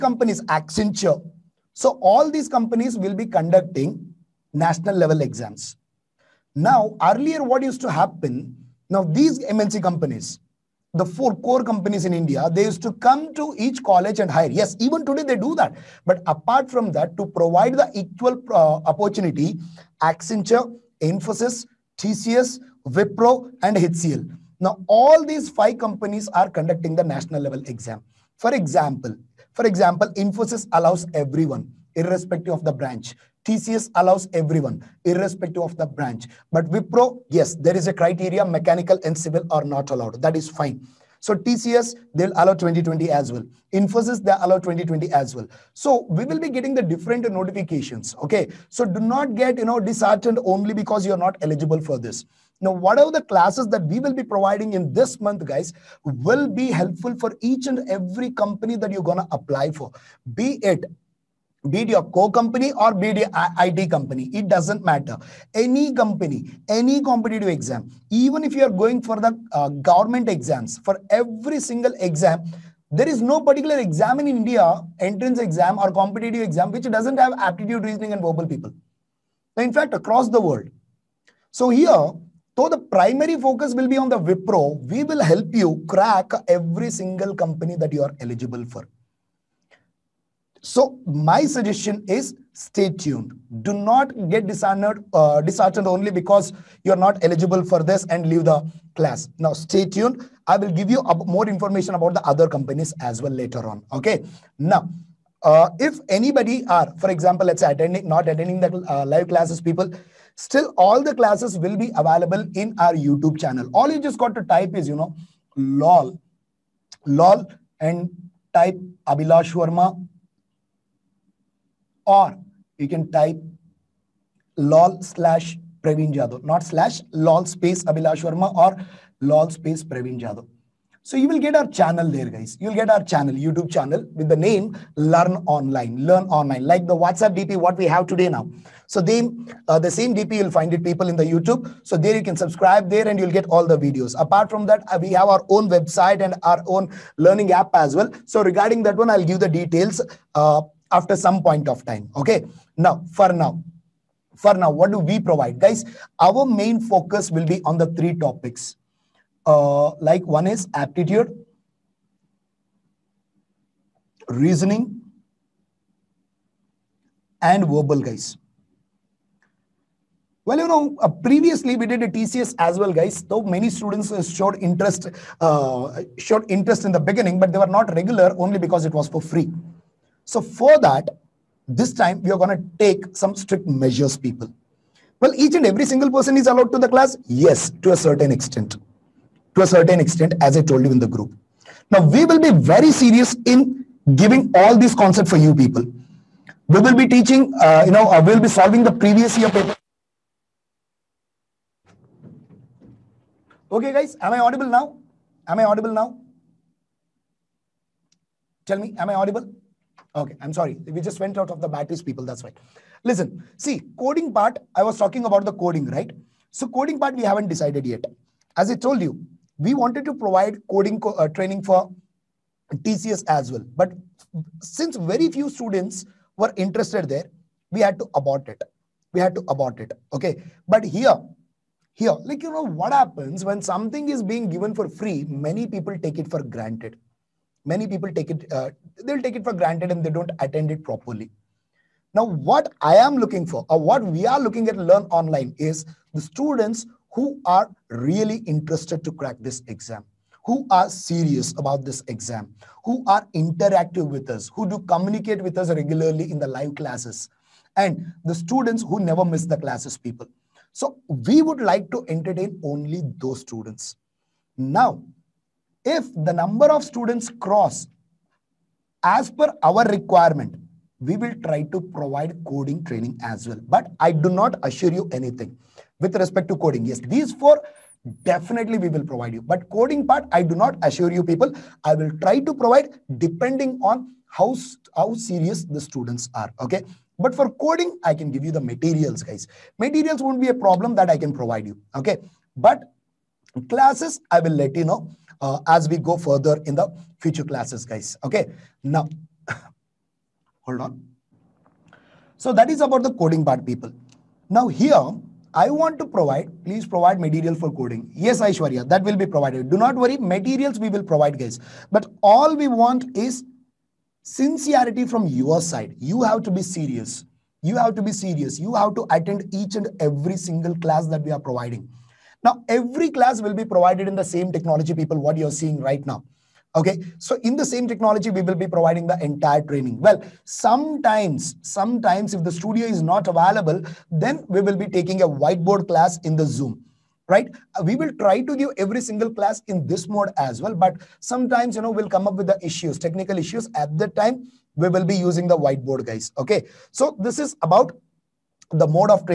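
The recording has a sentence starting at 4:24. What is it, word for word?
Now, if the number of students cross as per our requirement, we will try to provide coding training as well.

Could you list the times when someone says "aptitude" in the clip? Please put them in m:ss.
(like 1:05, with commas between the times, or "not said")
1:17, 2:40.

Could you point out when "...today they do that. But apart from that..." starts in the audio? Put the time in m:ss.
0:15.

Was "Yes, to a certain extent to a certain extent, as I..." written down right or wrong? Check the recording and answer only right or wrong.
right.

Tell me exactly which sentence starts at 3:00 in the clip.
So for that, this time we are going to take some strict measures, people.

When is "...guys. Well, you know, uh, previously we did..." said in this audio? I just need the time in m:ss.
2:48.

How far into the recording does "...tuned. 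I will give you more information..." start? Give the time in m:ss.
1:39.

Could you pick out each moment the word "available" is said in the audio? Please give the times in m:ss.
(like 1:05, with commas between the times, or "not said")
1:51, 5:33.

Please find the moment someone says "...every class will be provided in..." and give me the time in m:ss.
5:22.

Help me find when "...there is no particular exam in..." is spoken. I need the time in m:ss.
1:12.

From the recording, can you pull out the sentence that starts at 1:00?
Be it be it your co-company or be it IT company, it doesn't matter.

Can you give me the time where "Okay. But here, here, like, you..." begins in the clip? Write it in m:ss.
3:50.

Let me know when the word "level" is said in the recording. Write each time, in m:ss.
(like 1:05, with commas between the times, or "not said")
0:04, 0:27.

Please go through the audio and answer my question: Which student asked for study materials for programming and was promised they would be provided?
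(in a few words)
Aishwarya.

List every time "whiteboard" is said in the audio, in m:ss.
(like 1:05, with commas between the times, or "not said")
5:35, 5:45.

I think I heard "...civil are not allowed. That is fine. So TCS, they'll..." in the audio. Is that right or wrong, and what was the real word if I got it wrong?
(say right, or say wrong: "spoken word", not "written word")
right.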